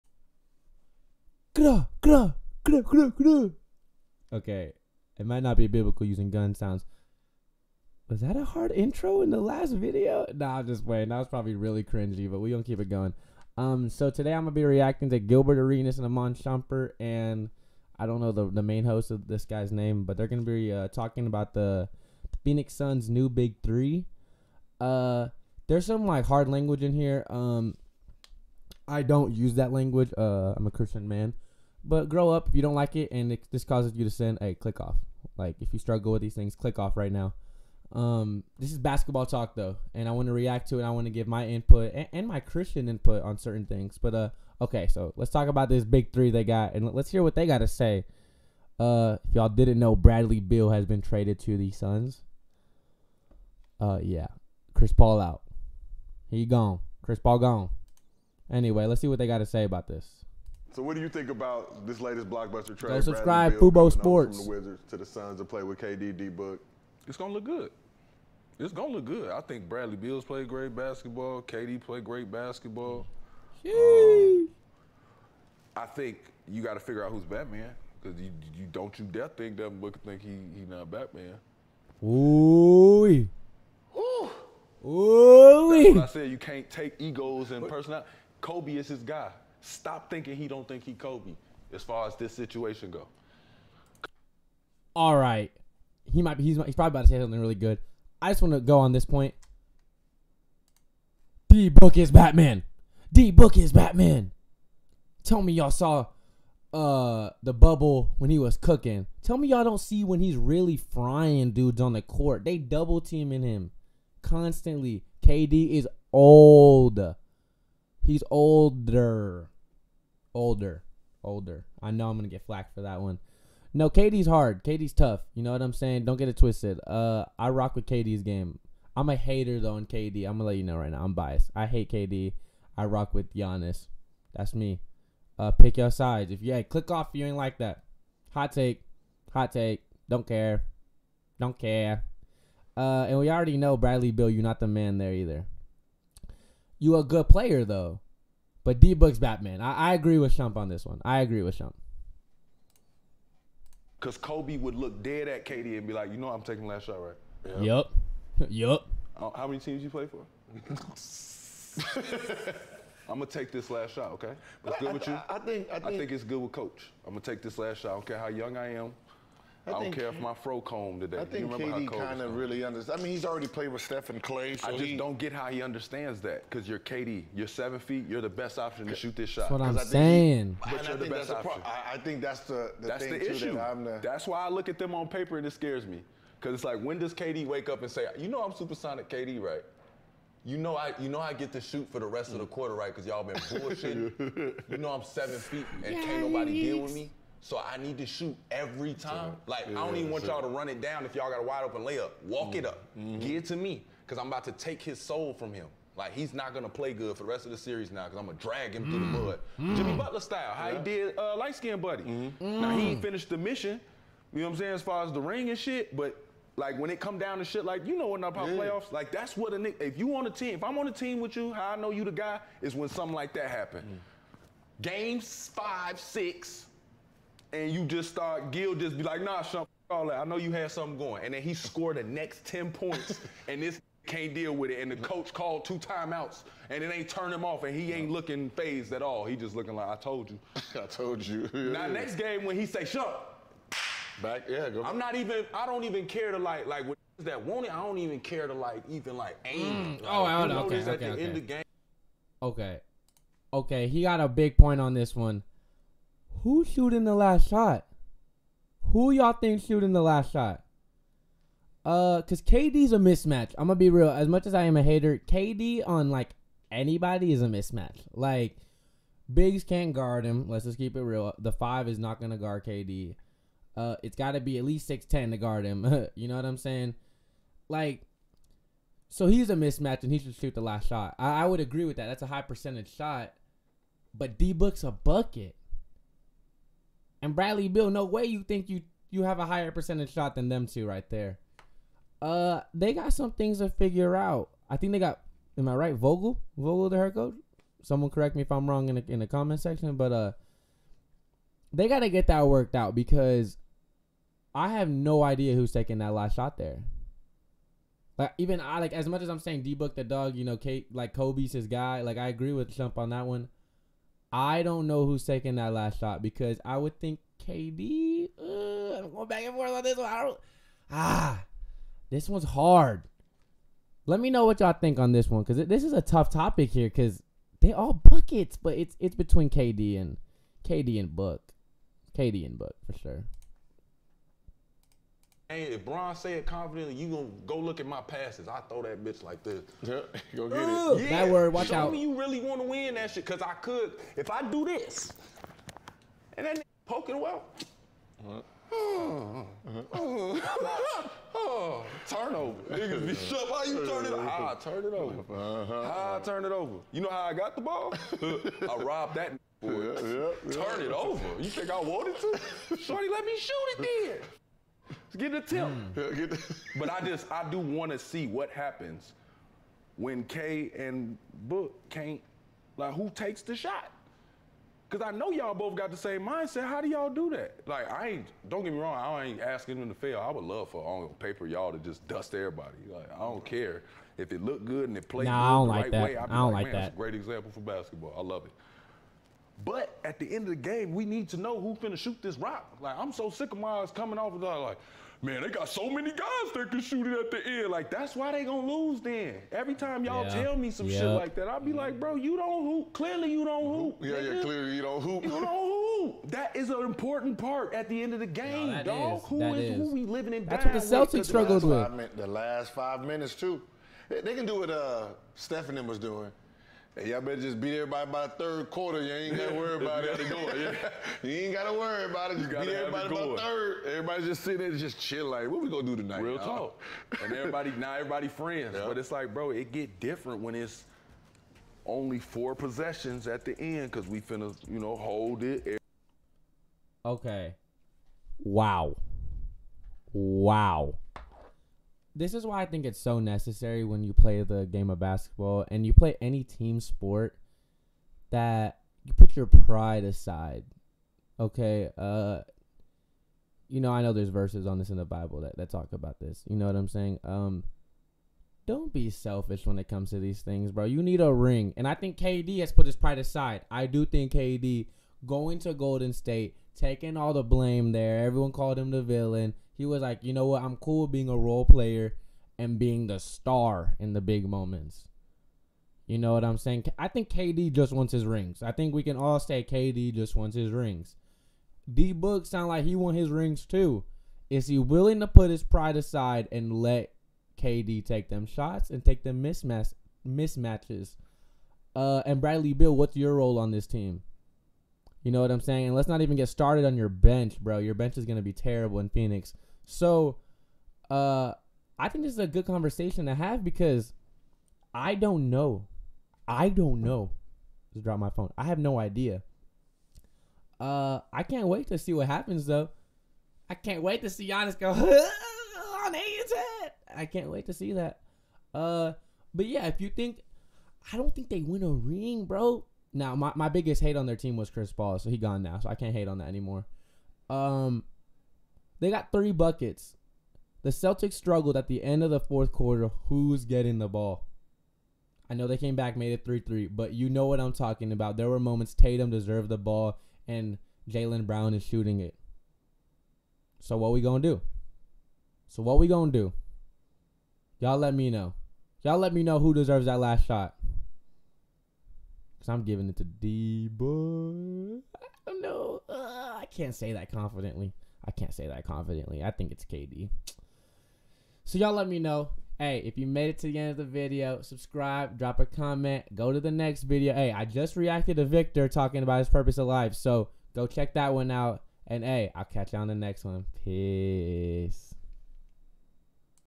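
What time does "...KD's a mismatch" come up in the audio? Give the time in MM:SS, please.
04:22.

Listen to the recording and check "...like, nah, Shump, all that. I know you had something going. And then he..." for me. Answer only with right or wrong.
right.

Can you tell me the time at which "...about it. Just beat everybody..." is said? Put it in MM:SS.
07:02.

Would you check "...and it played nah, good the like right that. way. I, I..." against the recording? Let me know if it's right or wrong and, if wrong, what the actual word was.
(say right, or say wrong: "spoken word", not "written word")
right.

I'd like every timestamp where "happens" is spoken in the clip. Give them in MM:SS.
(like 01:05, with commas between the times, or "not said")
03:43, 06:08, 08:32.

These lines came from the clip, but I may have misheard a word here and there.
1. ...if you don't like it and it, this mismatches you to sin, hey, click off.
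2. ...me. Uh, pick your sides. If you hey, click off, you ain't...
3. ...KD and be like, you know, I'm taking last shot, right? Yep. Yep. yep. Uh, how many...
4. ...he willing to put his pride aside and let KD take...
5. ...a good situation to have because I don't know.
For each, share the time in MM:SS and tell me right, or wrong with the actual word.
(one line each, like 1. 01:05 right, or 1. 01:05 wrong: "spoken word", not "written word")
1. 00:32 wrong: "causes", not "mismatches"
2. 02:14 right
3. 02:35 right
4. 08:04 right
5. 08:22 wrong: "conversation", not "situation".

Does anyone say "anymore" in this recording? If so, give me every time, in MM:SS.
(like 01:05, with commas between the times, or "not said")
08:46.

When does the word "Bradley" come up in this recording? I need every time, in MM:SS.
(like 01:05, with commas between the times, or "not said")
00:49, 01:09, 02:23, 04:47, 08:12.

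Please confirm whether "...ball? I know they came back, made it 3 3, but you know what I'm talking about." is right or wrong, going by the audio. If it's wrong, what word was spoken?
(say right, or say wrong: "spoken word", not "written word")
right.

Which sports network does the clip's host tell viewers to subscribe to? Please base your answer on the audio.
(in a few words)
Fubo Sports.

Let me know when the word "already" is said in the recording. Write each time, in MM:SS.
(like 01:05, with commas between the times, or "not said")
02:23, 02:53.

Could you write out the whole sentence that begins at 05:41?
me you really want to win that shit, cause I could.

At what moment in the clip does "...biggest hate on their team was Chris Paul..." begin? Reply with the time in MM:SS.
08:43.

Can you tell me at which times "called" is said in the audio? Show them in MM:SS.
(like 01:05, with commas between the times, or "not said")
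03:55, 07:48.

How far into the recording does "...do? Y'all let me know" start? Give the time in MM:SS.
09:06.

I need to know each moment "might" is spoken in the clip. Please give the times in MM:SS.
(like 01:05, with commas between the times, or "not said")
00:05, 01:36.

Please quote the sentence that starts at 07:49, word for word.
He was like, you know what?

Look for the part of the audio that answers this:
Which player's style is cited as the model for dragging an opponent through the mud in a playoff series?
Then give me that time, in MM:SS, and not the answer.
03:29.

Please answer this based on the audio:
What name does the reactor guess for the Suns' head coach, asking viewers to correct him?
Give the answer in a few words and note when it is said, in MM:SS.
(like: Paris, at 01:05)
Vogel, at 04:55.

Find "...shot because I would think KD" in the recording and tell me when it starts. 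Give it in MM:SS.
05:15.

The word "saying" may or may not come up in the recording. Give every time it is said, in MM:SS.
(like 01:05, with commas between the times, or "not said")
02:05, 02:59, 03:34, 04:36, 05:09, 07:36, 07:56, 08:15.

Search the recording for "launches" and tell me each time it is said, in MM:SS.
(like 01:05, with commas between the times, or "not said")
not said.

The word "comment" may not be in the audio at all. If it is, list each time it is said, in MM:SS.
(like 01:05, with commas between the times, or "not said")
04:59, 09:25.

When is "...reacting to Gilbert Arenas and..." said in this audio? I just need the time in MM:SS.
00:14.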